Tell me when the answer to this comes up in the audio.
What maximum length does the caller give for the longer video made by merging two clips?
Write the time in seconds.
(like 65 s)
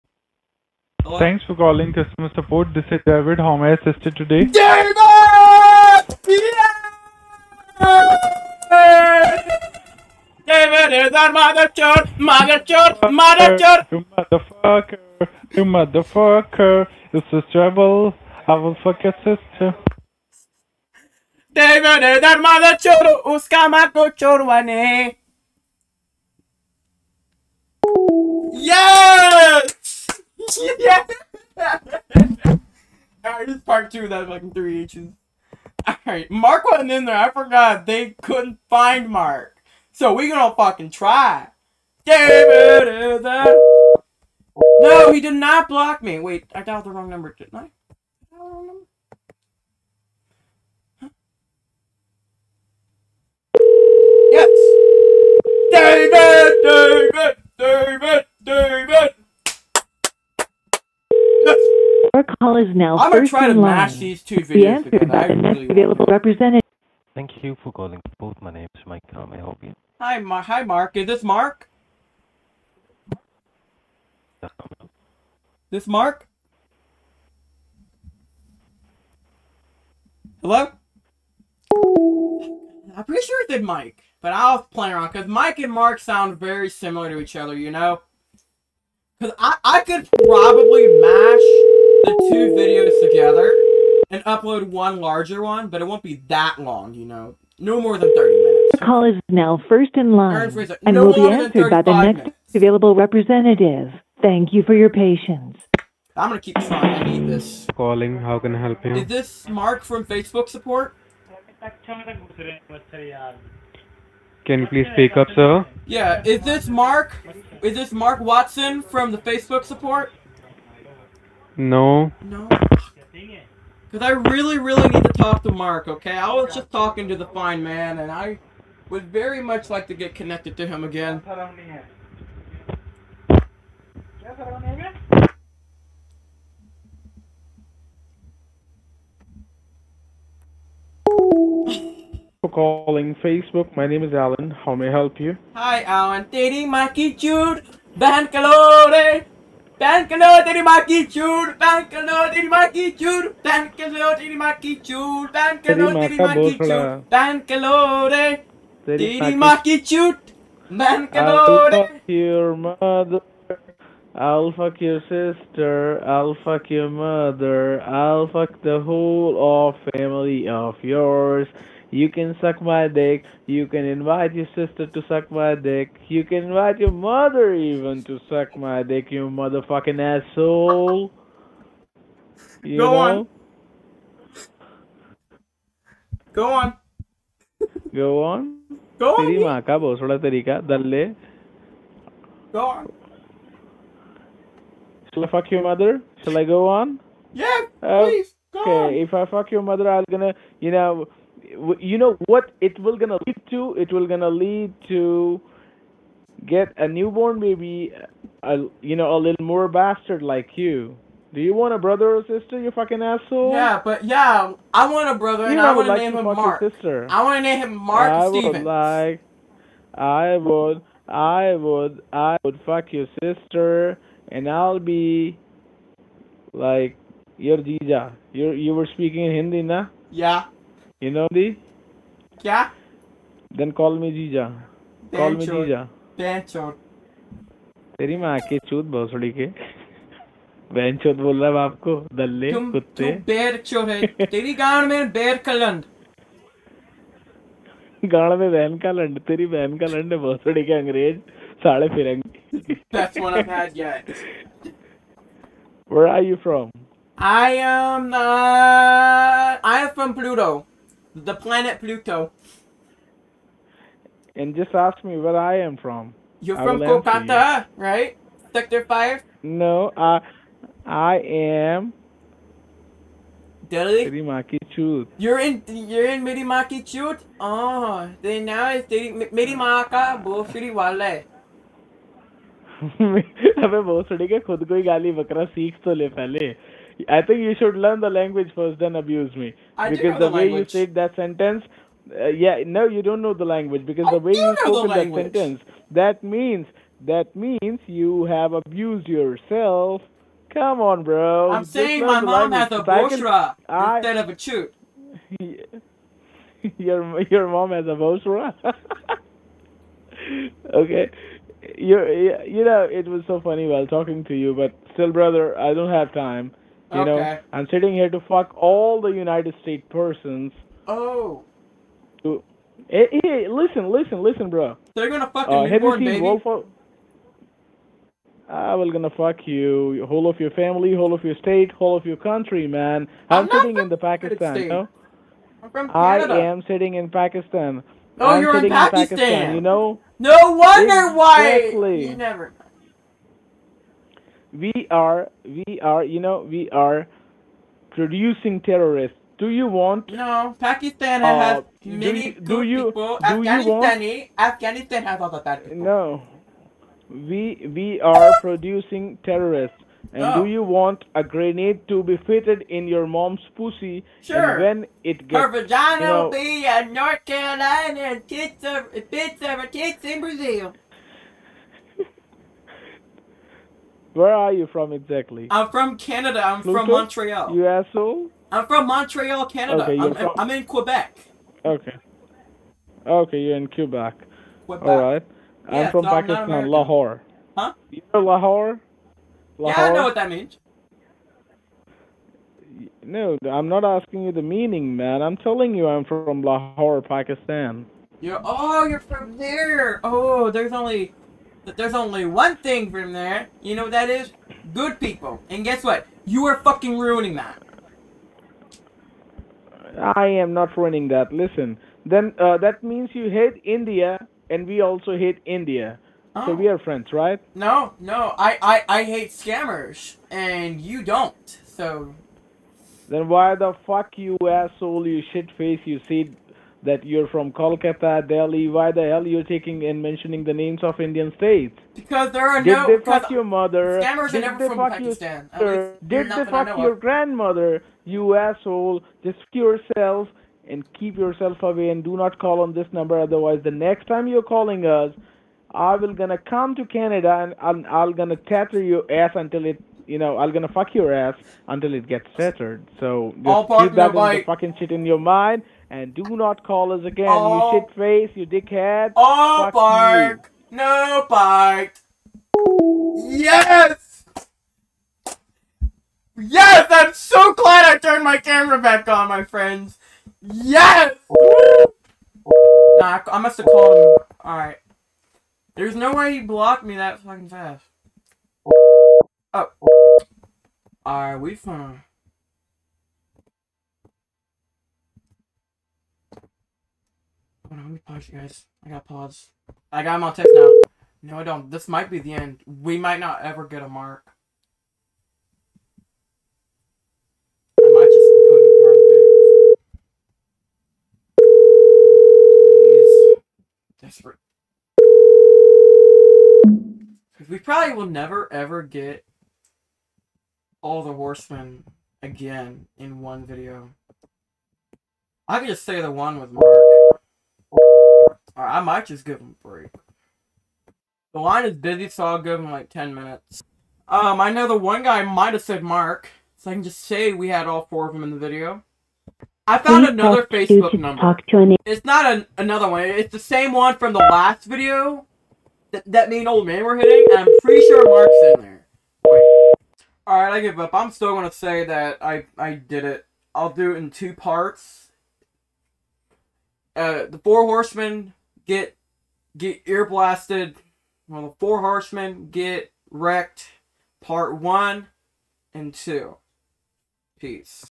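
98 s.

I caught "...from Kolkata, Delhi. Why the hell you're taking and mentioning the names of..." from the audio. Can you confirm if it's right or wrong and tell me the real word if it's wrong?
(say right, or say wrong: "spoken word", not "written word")
right.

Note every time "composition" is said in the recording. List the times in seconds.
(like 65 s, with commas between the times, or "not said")
not said.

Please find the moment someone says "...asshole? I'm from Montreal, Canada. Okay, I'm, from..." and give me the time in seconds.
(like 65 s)
377 s.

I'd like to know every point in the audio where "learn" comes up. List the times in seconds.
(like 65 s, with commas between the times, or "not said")
287 s.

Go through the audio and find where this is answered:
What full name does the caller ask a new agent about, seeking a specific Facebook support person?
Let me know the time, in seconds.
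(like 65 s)
117 s.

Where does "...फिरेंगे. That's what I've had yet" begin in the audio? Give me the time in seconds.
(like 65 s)
251 s.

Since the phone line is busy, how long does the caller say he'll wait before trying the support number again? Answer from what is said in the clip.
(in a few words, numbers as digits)
10 minutes.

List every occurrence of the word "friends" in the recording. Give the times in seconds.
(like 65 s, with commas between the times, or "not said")
416 s, 469 s.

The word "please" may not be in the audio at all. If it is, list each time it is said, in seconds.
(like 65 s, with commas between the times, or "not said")
114 s, 197 s, 530 s.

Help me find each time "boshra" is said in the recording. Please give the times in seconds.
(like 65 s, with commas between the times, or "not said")
303 s, 307 s.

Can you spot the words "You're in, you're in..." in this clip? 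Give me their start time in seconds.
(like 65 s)
275 s.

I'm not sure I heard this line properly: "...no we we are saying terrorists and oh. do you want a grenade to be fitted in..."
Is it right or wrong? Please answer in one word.
wrong.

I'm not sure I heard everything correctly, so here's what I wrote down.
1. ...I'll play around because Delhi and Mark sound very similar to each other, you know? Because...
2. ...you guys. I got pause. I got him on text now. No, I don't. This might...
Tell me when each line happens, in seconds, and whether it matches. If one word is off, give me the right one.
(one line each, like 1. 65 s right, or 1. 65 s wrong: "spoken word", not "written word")
1. 84 s wrong: "Mike", not "Delhi"
2. 488 s right.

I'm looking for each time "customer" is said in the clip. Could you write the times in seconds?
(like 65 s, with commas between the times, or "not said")
1 s.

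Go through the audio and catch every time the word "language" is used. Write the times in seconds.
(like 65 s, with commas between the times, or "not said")
288 s, 293 s, 302 s.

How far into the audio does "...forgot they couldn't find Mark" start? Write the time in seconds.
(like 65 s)
37 s.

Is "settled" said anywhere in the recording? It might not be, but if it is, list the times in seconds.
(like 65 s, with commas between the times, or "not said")
452 s.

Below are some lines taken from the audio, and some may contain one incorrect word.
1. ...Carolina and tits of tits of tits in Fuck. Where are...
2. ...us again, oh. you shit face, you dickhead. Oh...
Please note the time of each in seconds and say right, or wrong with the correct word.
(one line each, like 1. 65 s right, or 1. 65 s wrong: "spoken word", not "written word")
1. 367 s wrong: "Brazil", not "Fuck"
2. 456 s right.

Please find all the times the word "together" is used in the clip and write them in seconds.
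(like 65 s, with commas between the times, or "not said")
64 s, 93 s.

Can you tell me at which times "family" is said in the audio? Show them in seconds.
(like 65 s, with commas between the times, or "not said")
169 s, 330 s.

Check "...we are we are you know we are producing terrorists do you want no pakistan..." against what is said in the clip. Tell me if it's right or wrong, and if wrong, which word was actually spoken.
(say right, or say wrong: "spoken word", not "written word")
right.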